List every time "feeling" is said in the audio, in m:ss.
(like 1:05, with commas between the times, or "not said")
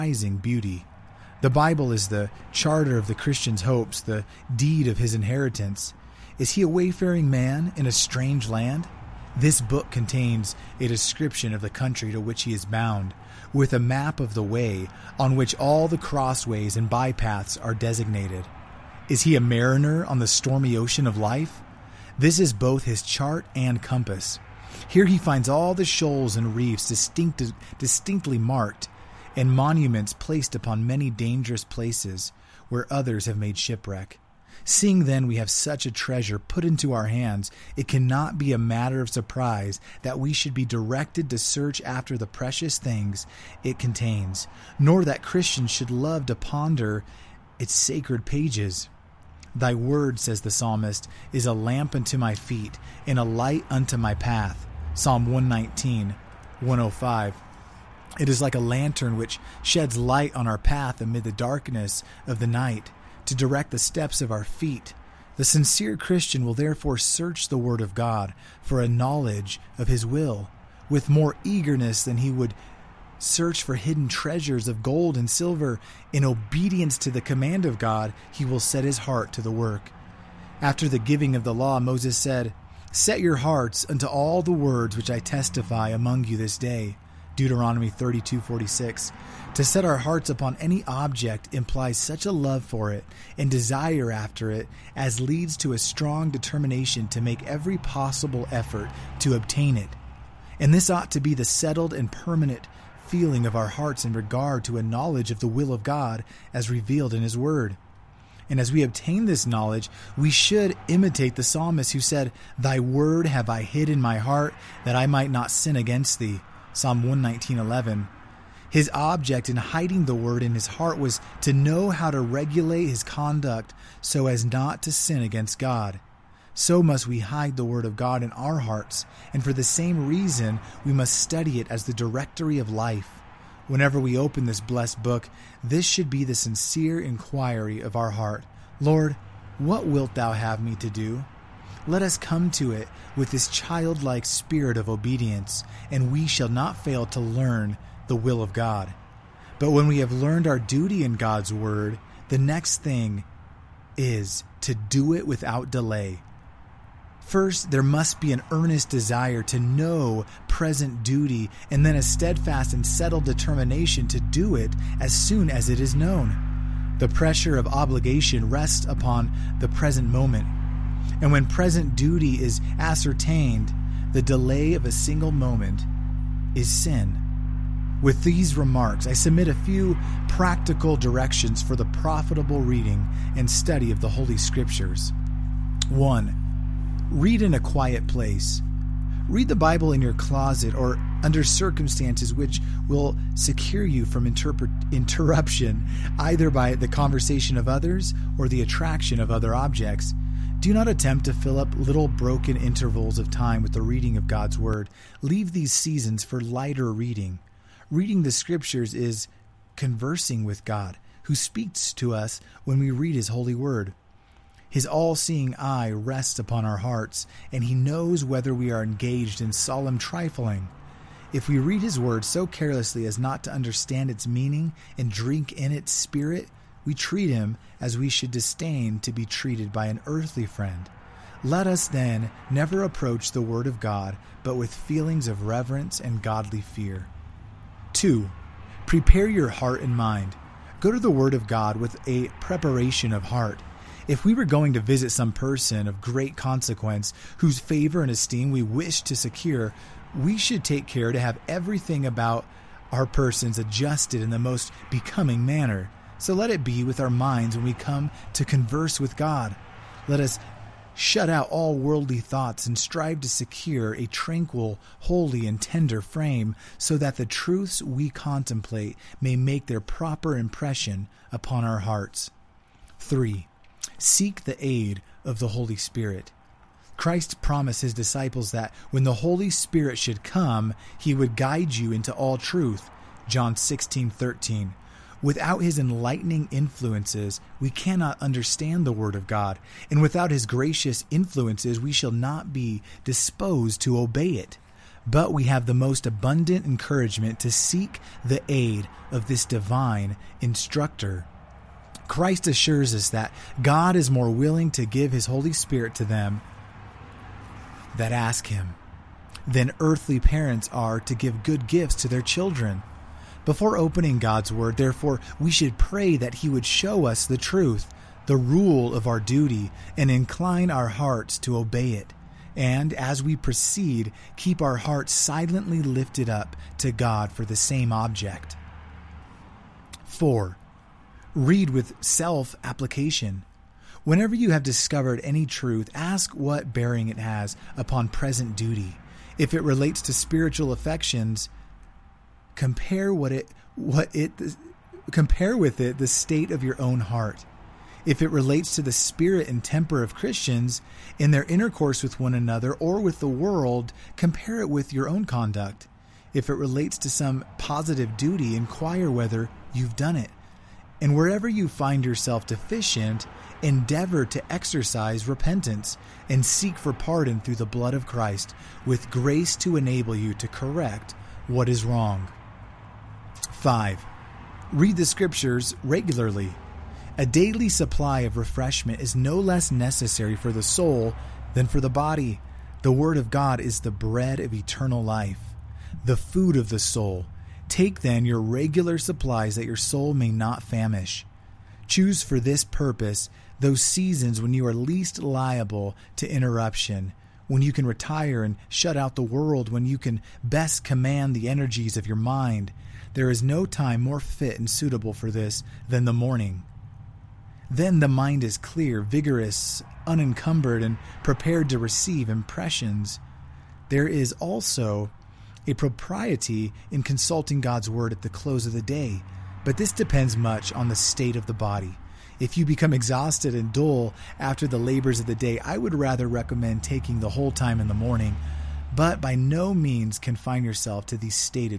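1:43, 3:54.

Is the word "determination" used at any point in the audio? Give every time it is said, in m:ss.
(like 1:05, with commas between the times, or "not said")
1:36, 2:43.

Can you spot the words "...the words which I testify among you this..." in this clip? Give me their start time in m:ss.
1:24.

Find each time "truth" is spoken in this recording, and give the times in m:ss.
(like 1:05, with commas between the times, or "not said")
4:27, 4:42, 5:17, 5:35.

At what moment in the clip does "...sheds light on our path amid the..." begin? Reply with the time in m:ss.
0:59.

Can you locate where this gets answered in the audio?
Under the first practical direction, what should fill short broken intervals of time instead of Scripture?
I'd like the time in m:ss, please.
3:26.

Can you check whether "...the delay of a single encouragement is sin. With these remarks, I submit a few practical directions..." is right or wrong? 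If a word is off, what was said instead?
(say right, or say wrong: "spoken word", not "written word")
wrong: "moment", not "encouragement".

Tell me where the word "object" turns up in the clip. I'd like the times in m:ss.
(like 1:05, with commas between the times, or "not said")
1:30, 1:58, 3:19, 5:27.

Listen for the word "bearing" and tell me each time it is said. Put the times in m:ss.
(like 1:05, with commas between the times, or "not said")
5:36.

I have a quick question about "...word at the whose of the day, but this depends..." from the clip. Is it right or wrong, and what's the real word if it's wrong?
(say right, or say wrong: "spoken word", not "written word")
wrong: "close", not "whose".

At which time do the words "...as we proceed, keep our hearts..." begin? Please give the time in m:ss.
5:22.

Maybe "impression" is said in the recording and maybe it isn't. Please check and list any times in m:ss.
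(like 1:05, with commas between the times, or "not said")
4:30, 6:52.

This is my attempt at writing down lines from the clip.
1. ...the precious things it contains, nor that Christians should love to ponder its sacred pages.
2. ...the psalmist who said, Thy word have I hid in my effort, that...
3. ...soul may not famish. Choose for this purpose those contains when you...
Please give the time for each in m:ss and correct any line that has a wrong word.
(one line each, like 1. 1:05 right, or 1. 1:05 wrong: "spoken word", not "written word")
1. 0:42 right
2. 1:51 wrong: "heart", not "effort"
3. 6:29 wrong: "seasons", not "contains".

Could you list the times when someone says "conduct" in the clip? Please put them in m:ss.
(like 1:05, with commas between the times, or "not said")
2:03, 5:55.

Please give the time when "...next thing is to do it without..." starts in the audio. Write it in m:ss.
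2:32.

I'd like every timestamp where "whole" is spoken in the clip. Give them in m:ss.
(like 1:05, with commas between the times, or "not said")
7:07.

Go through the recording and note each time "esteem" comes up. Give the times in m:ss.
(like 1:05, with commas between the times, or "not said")
4:08.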